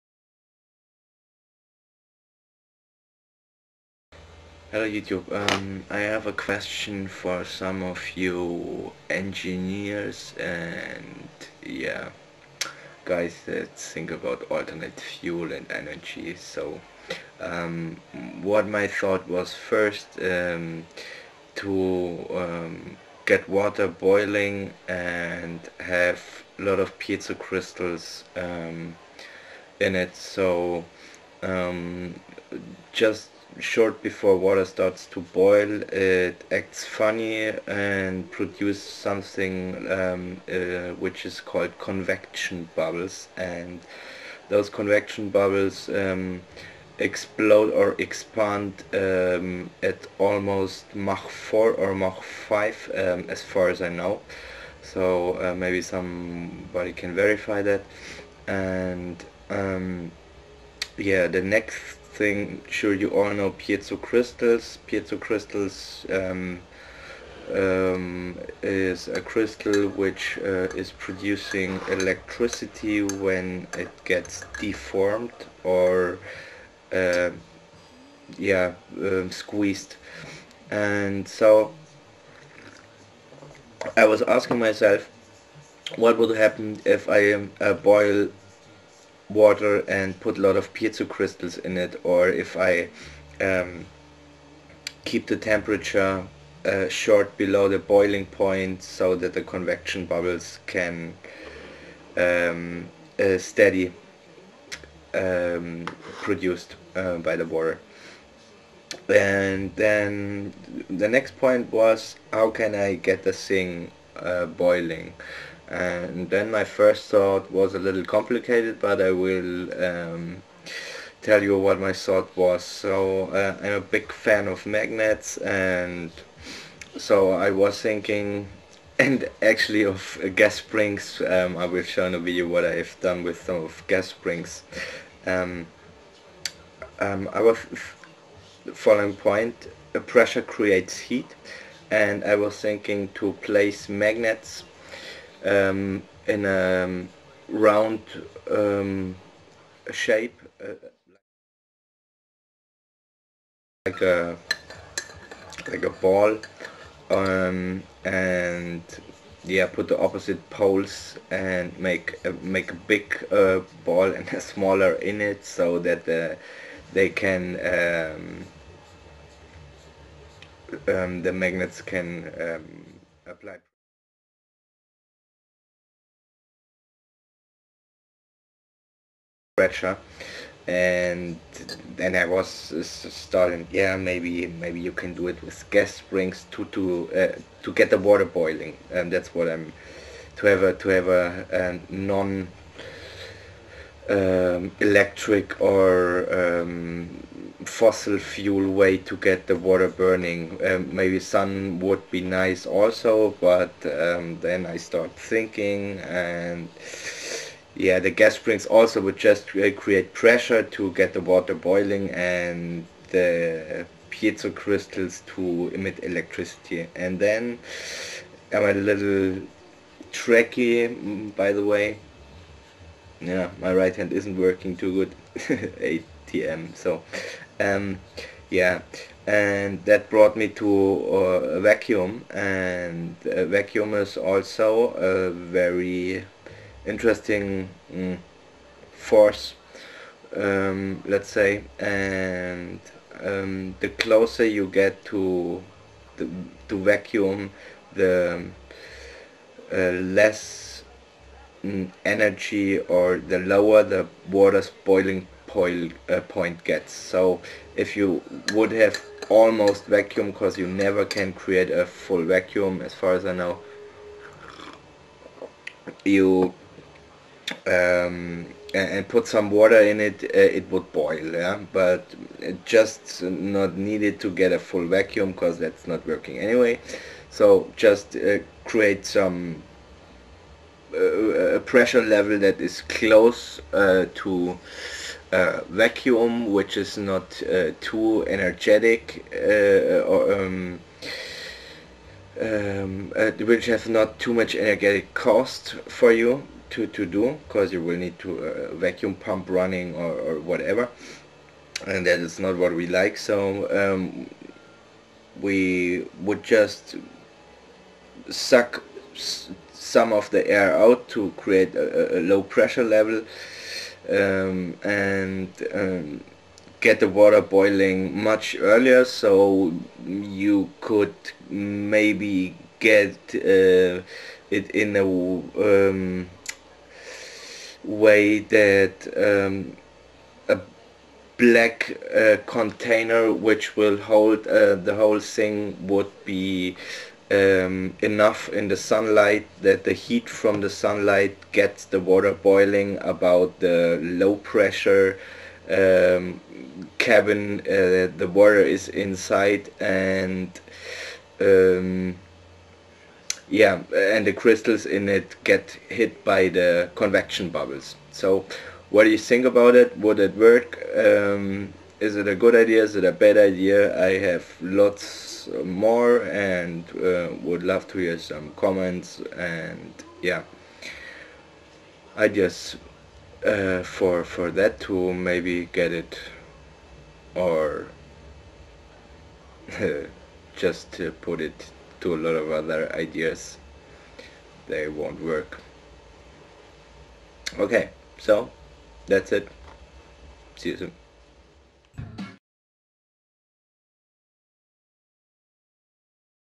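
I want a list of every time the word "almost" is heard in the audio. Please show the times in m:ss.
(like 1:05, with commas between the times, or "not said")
0:50, 4:19.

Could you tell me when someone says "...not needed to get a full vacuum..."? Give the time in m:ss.
4:33.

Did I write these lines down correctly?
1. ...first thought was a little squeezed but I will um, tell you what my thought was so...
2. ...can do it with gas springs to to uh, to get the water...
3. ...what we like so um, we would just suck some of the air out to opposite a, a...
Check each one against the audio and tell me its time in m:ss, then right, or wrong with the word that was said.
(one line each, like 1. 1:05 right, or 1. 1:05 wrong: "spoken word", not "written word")
1. 1:56 wrong: "complicated", not "squeezed"
2. 3:04 right
3. 5:02 wrong: "create", not "opposite".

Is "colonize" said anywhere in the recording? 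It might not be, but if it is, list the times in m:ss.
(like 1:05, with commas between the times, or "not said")
not said.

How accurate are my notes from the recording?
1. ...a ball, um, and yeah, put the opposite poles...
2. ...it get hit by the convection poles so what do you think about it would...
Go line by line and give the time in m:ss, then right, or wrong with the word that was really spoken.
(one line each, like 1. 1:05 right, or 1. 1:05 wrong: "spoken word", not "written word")
1. 2:35 right
2. 5:55 wrong: "bubbles", not "poles".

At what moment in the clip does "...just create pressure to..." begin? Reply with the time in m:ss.
3:29.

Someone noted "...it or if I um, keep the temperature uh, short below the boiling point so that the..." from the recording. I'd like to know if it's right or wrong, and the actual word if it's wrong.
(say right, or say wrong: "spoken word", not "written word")
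right.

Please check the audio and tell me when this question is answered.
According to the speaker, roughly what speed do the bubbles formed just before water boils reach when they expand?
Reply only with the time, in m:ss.
0:50.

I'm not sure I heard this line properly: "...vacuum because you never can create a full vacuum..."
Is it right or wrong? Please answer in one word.
right.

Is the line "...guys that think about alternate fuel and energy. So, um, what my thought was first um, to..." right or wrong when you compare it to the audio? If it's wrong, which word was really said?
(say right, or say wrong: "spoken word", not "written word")
right.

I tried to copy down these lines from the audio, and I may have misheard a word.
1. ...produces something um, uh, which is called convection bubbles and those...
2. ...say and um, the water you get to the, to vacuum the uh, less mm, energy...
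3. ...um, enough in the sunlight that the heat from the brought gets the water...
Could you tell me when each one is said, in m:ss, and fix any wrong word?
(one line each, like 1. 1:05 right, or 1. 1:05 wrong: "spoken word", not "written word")
1. 0:38 right
2. 4:01 wrong: "closer", not "water"
3. 5:37 wrong: "sunlight", not "brought".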